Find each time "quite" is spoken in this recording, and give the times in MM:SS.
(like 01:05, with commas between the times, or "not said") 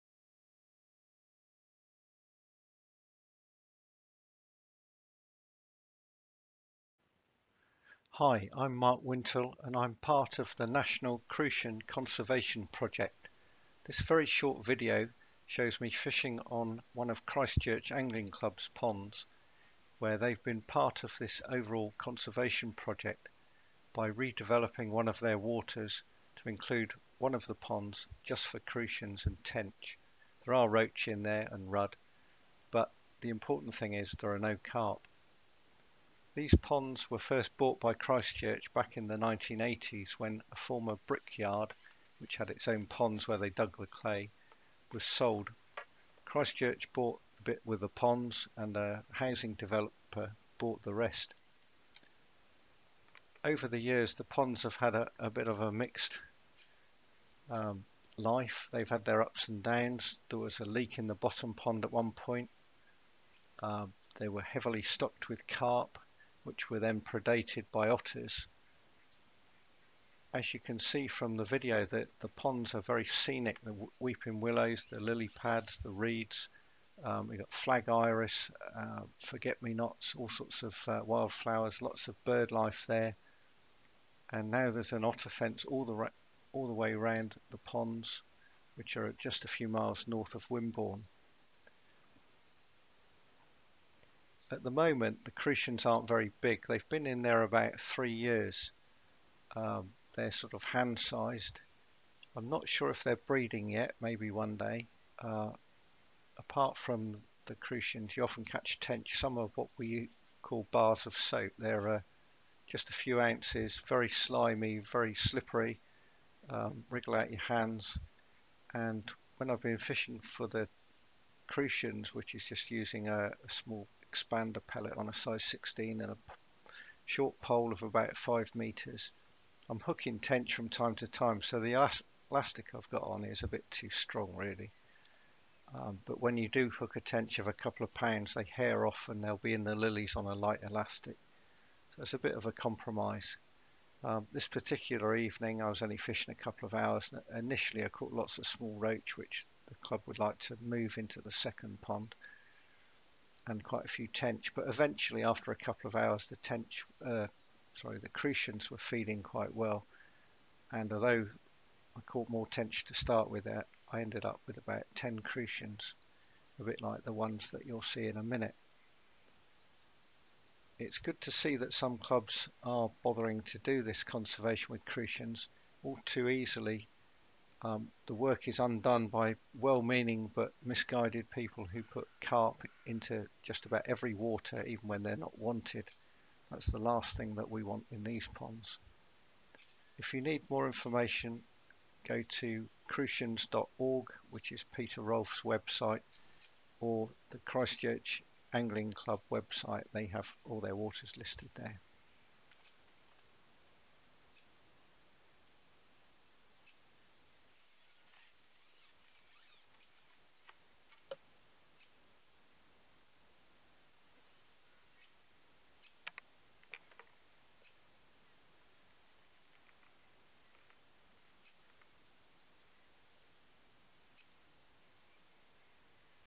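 02:33, 02:39.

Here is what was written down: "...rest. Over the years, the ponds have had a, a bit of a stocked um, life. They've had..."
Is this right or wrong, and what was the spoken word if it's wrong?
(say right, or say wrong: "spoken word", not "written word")
wrong: "mixed", not "stocked".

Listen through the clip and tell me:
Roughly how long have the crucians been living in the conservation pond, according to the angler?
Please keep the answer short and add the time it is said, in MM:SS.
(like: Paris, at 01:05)
3 years, at 01:37.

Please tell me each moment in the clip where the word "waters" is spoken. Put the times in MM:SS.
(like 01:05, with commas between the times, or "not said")
00:25, 03:04, 03:20.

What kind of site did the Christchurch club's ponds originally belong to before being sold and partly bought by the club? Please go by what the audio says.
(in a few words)
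Brickyard.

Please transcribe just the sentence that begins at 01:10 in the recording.
As you can see from the video, the, the ponds are very scenic.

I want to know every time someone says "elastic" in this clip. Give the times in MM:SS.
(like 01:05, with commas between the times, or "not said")
02:12, 02:20.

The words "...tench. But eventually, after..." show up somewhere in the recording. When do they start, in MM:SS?
02:34.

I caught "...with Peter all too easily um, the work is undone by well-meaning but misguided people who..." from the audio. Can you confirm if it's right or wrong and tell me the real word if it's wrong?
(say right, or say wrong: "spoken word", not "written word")
wrong: "Crucians", not "Peter".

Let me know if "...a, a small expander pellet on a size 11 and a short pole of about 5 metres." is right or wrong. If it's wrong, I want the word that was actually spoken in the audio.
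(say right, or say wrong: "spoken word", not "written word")
wrong: "16", not "11".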